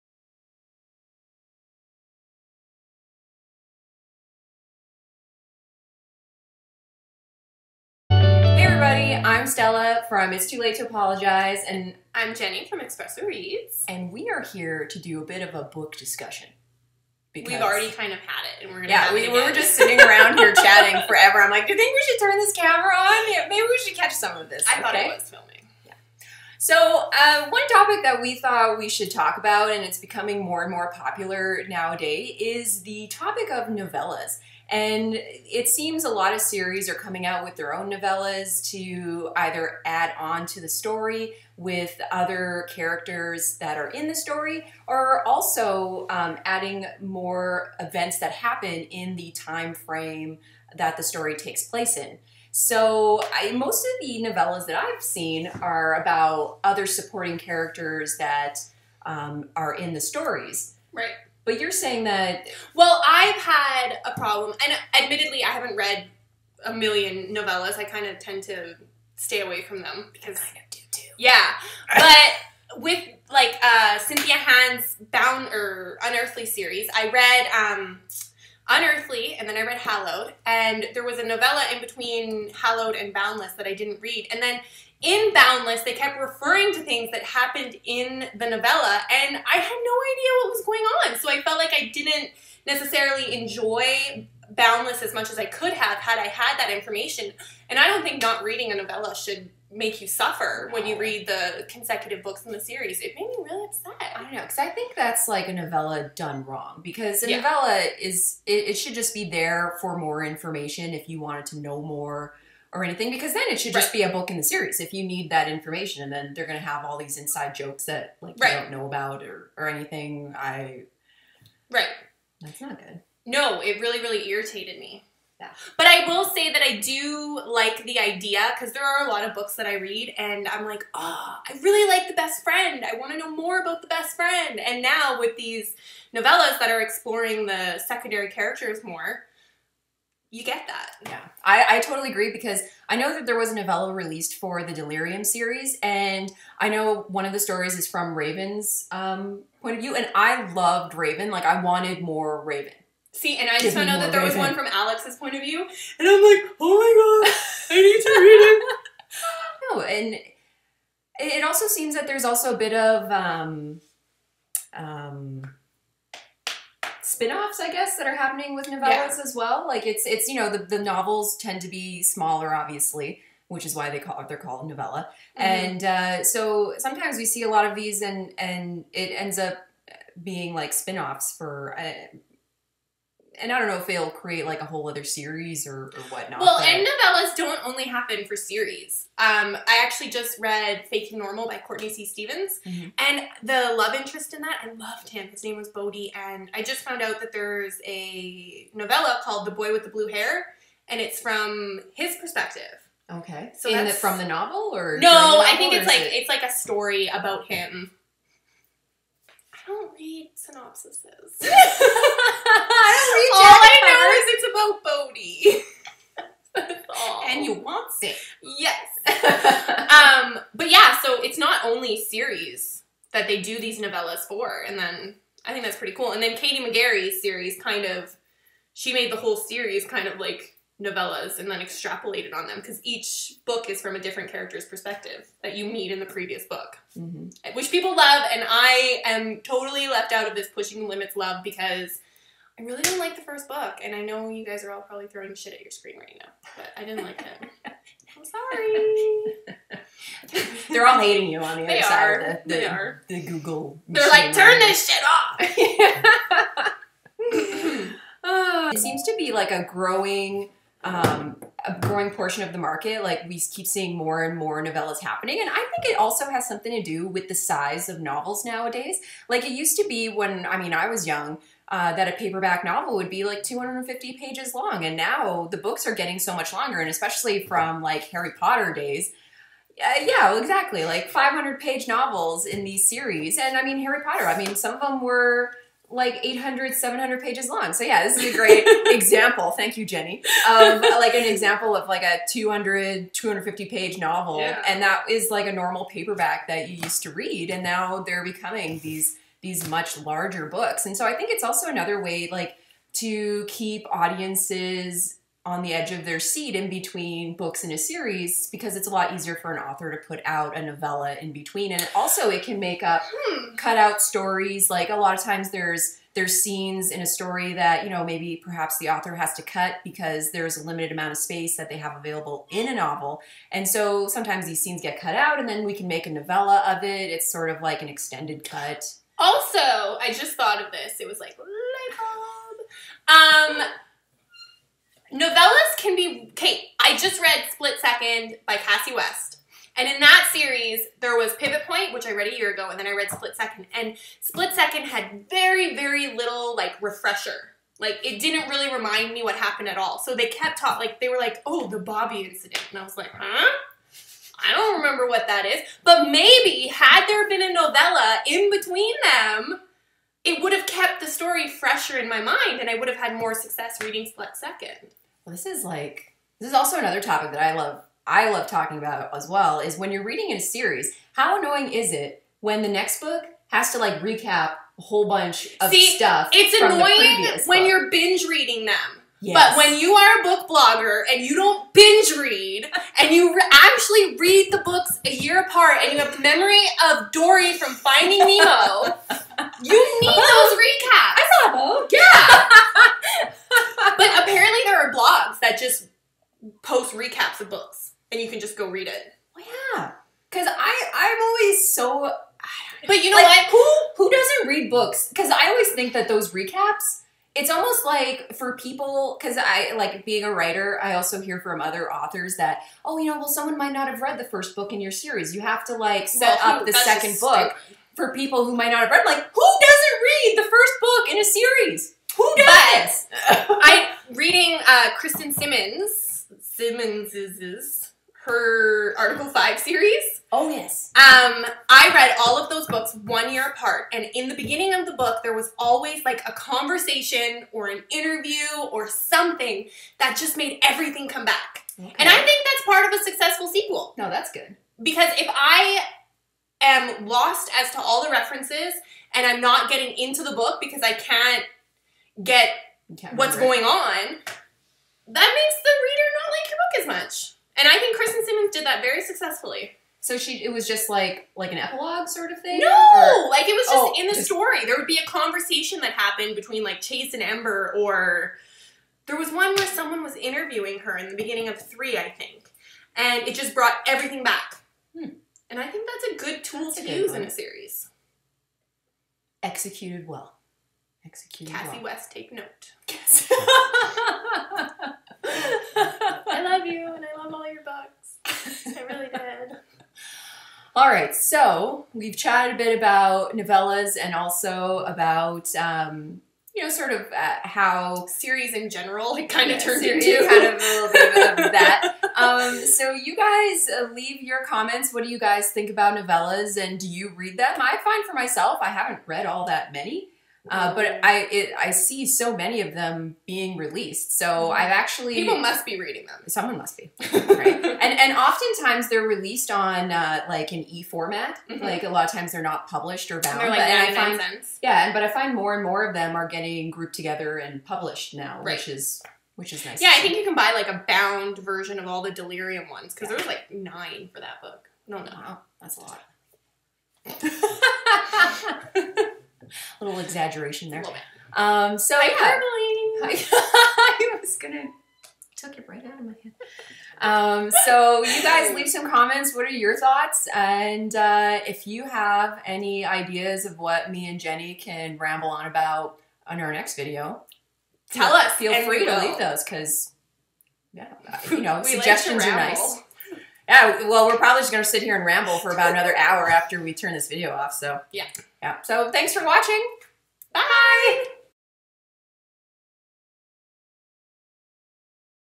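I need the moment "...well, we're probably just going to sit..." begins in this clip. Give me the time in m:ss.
9:23.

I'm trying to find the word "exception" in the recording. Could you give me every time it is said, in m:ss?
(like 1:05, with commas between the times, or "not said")
not said.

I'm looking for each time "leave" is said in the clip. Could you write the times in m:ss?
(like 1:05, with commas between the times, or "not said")
8:23, 9:08, 9:18.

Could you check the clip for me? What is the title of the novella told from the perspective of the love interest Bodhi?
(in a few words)
The Boy with the Blue Hair.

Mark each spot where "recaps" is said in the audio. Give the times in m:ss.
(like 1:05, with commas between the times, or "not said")
6:14, 6:30, 6:36, 6:46.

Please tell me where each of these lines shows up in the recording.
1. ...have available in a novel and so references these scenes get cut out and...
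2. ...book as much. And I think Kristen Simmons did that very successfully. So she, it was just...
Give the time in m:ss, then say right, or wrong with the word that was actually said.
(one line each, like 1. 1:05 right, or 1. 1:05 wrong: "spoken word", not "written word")
1. 5:21 wrong: "sometimes", not "references"
2. 7:36 right.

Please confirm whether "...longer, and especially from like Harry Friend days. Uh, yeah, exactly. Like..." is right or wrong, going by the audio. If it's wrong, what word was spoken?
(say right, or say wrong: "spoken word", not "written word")
wrong: "Potter", not "Friend".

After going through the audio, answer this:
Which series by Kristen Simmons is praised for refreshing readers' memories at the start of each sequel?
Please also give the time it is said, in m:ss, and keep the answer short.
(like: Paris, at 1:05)
Article Five, at 7:08.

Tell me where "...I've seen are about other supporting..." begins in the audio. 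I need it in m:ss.
0:54.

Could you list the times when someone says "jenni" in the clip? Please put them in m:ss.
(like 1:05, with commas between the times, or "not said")
0:12, 4:49, 9:14.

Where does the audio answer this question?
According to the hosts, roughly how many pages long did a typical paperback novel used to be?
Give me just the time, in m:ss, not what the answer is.
4:33.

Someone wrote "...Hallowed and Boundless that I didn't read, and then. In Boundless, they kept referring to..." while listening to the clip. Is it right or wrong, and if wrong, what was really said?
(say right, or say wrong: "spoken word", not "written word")
right.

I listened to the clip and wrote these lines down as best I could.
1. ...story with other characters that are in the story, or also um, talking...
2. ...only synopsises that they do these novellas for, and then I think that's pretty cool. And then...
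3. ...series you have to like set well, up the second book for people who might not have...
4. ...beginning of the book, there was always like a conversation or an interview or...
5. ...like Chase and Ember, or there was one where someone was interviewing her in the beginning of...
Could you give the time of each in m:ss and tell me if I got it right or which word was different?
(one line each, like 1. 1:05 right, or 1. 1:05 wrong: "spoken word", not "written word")
1. 0:40 wrong: "adding", not "talking"
2. 3:41 wrong: "series", not "synopsises"
3. 6:54 right
4. 7:14 right
5. 7:46 right.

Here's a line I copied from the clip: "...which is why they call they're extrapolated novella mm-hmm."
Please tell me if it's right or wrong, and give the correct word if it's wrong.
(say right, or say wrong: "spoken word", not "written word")
wrong: "called", not "extrapolated".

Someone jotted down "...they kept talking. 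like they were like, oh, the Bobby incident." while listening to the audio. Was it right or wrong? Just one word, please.
right.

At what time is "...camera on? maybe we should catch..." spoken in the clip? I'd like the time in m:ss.
0:22.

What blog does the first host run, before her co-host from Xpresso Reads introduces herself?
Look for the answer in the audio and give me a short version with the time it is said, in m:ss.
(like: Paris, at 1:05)
It's Too Late to Apologize, at 0:10.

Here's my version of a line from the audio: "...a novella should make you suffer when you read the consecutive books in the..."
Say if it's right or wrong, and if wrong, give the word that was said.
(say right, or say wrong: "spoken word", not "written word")
right.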